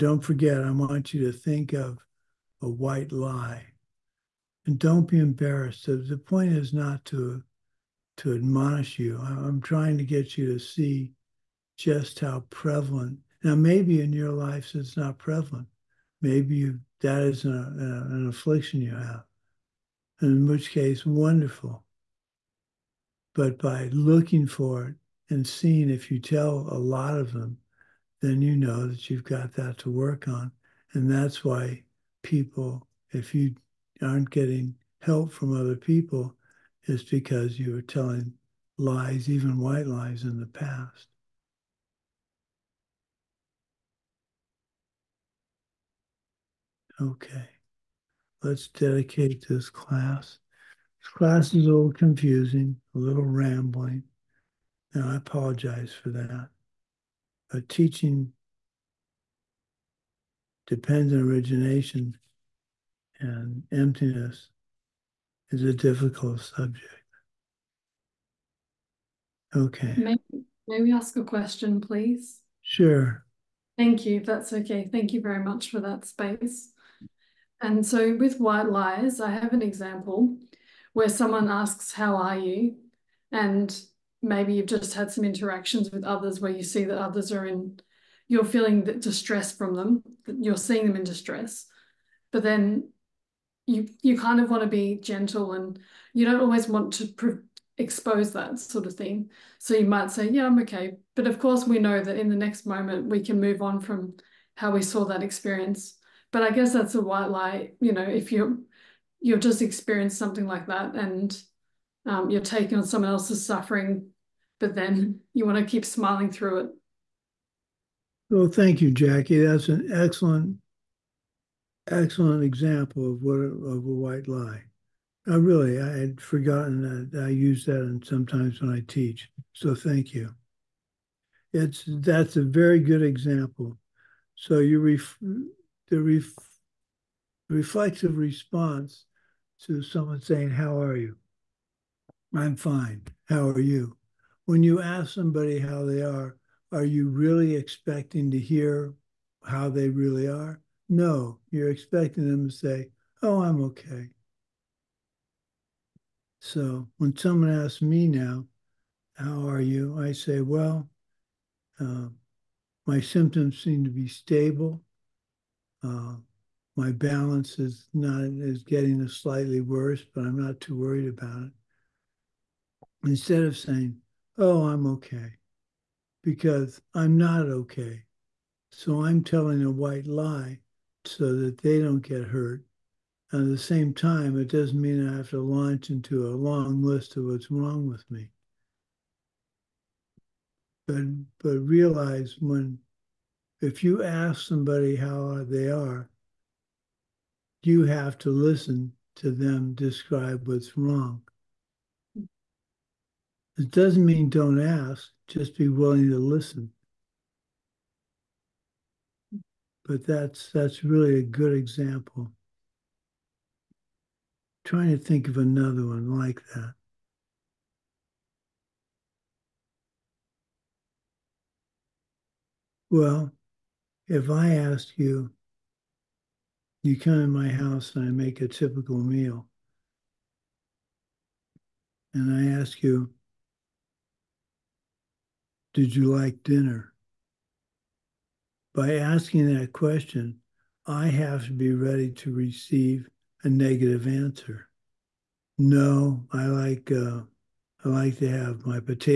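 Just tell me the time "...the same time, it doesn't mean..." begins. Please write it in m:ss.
3:03.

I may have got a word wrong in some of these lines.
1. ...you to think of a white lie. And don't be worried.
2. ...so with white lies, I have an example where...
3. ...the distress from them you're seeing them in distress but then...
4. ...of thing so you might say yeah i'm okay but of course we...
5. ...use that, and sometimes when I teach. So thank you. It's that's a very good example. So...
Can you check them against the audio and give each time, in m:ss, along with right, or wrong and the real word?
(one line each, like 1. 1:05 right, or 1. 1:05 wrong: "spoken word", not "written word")
1. 0:01 wrong: "embarrassed", not "worried"
2. 1:17 right
3. 1:28 right
4. 1:38 right
5. 2:07 right.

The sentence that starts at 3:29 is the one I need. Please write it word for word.
But that's that's really a good example.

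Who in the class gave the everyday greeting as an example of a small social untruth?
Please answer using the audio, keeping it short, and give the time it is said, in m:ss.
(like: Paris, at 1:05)
Jackie, at 1:58.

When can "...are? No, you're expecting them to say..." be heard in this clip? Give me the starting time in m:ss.
2:30.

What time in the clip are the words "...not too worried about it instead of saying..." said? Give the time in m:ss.
2:50.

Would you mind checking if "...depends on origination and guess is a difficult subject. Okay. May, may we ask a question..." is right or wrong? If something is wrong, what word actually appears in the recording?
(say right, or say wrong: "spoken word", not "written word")
wrong: "emptiness", not "guess".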